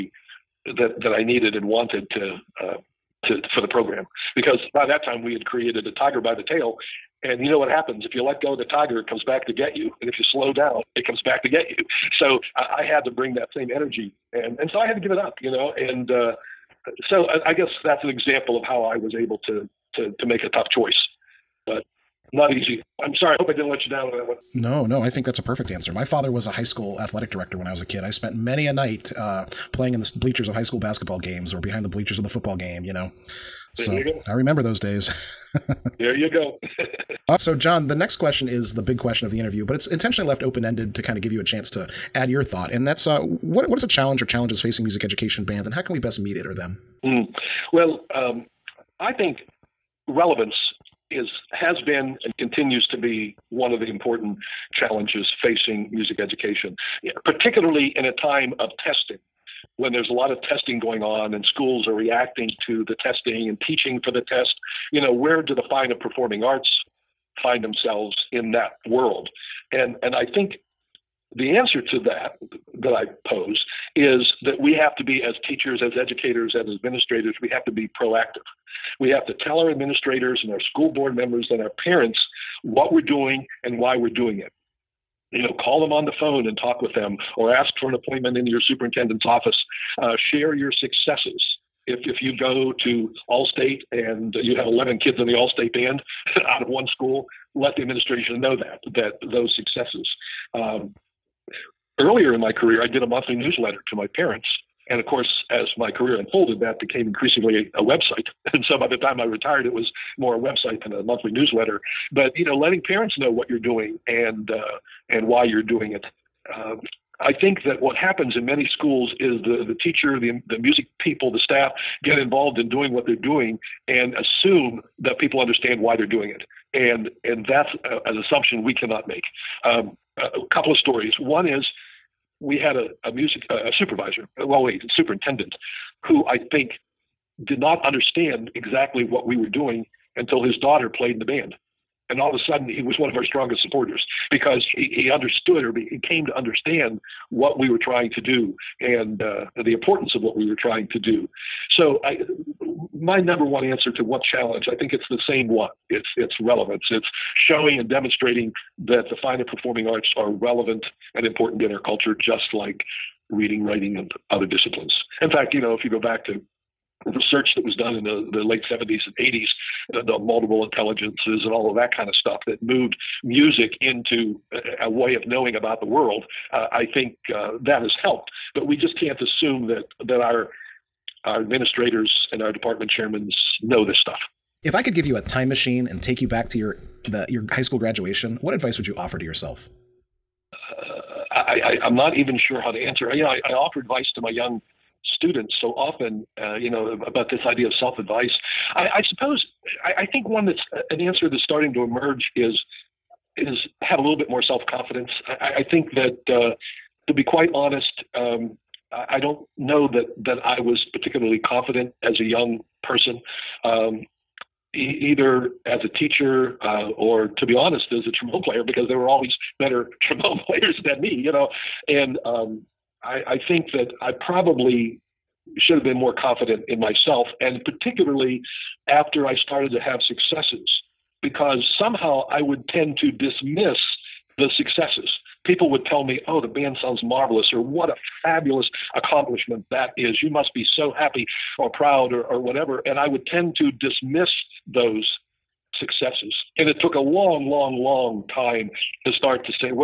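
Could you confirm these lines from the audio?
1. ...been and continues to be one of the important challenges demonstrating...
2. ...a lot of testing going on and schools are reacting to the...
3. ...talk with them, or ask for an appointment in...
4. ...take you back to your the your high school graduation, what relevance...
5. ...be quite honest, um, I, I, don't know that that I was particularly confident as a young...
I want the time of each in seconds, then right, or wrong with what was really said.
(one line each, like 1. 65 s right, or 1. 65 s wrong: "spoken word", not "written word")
1. 51 s wrong: "facing", not "demonstrating"
2. 60 s right
3. 86 s right
4. 186 s wrong: "advice", not "relevance"
5. 207 s right.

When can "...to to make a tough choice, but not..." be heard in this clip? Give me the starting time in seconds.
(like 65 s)
19 s.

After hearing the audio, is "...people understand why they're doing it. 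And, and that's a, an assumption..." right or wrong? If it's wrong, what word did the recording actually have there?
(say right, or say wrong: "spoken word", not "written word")
right.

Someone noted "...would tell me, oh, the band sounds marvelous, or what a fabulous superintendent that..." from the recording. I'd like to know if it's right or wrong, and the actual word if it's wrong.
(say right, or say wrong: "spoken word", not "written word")
wrong: "accomplishment", not "superintendent".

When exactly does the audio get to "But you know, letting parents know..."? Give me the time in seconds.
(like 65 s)
112 s.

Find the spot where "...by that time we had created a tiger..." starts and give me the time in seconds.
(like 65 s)
4 s.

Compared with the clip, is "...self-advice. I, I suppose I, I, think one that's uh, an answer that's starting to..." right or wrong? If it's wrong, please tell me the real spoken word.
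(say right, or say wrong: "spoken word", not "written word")
right.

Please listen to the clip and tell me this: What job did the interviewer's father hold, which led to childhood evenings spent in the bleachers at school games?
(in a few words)
High school athletic director.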